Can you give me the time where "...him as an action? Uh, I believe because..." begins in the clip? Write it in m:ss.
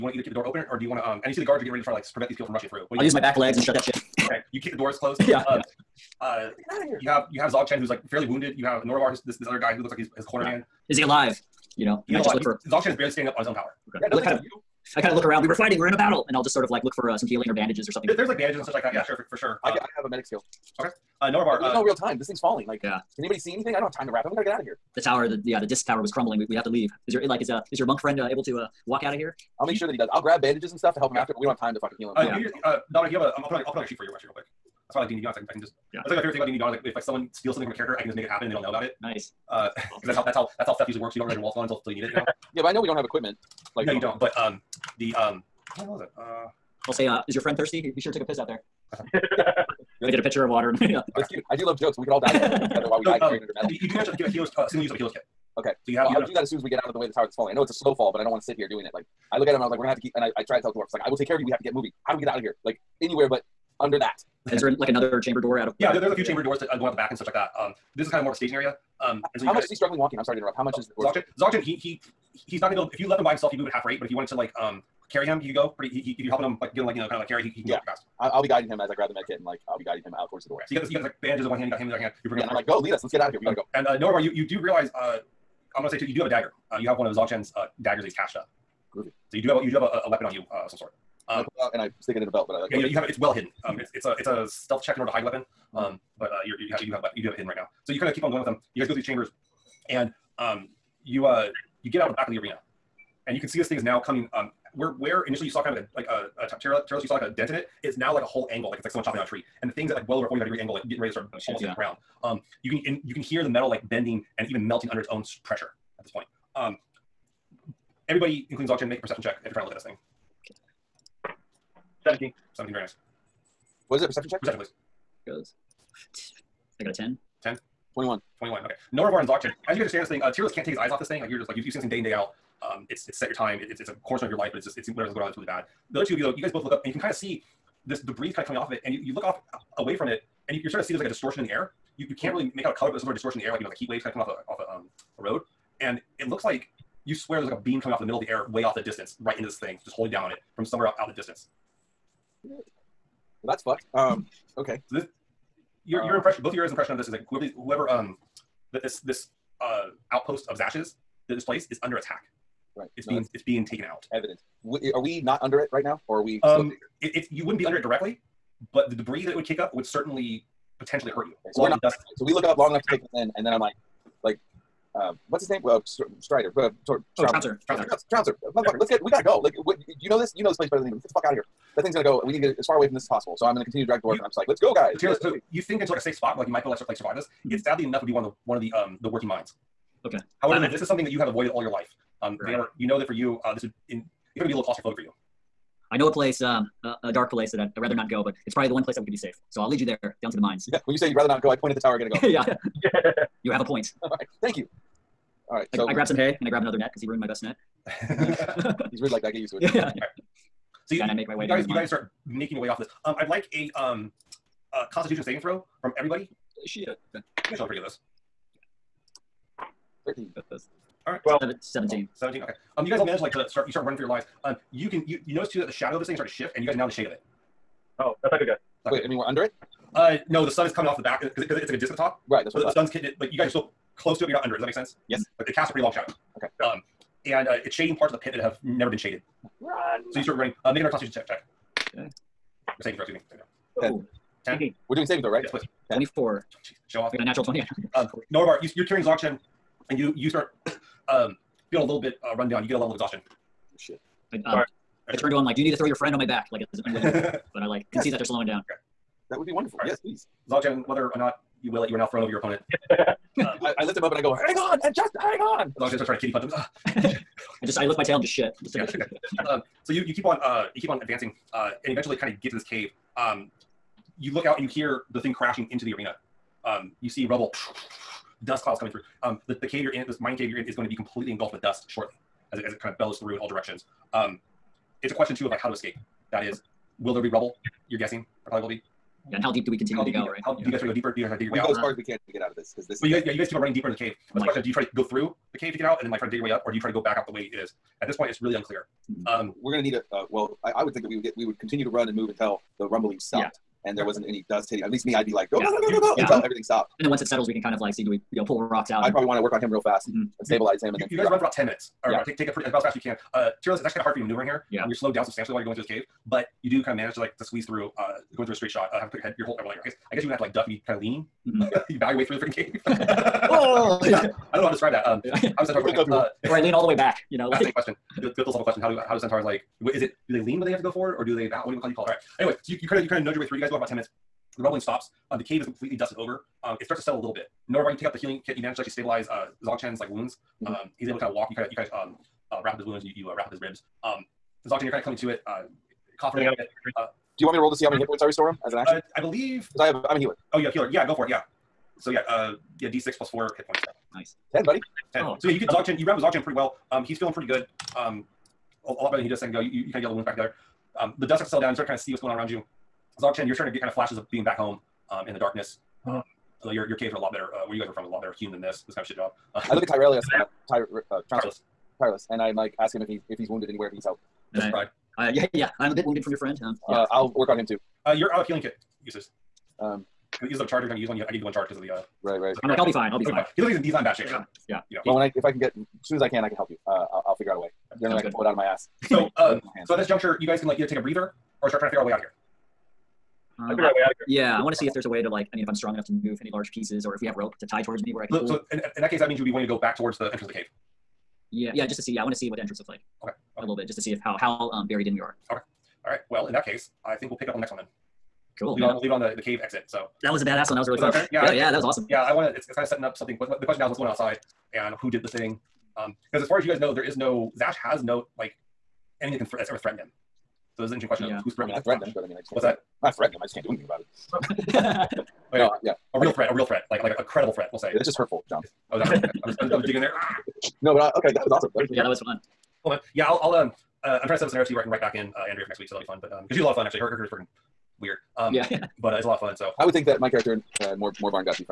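5:48.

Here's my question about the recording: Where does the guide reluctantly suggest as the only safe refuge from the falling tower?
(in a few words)
the mines.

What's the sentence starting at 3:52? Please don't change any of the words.
So the, the, sun's hitting it.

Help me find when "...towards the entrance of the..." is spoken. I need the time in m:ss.
6:39.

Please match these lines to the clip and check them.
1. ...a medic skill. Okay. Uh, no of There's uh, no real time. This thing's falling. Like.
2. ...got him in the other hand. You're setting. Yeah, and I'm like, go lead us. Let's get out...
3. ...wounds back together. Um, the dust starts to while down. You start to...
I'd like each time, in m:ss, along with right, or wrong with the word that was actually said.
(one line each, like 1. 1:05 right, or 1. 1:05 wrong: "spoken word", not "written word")
1. 0:20 right
2. 1:21 wrong: "bringing", not "setting"
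3. 6:00 wrong: "settle", not "while".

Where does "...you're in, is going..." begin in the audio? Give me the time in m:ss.
4:40.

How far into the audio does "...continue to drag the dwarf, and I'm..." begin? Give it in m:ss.
3:03.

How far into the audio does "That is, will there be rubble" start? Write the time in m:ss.
4:46.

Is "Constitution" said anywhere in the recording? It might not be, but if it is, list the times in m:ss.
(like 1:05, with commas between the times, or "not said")
3:34, 4:00.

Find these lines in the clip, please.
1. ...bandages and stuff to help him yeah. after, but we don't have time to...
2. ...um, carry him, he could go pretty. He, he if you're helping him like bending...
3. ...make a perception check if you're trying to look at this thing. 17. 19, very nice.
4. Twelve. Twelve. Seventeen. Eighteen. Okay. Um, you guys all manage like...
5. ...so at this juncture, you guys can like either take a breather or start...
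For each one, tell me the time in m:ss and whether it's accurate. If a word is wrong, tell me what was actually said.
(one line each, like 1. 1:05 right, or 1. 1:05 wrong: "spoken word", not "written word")
1. 0:30 right
2. 1:14 wrong: "giving", not "bending"
3. 1:58 wrong: "17", not "19"
4. 3:41 wrong: "Seventeen", not "Eighteen"
5. 6:29 right.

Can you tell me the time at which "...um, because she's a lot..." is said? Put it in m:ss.
7:16.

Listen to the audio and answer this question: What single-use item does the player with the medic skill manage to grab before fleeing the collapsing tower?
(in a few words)
healer's kit.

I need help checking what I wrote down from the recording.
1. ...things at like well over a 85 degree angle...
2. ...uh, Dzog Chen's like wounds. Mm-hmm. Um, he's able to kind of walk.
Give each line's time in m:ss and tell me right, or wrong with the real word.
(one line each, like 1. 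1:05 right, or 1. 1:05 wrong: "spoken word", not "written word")
1. 1:49 wrong: "45", not "85"
2. 5:39 right.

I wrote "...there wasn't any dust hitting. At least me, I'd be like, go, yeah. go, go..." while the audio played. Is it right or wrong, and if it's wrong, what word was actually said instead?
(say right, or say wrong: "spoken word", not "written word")
right.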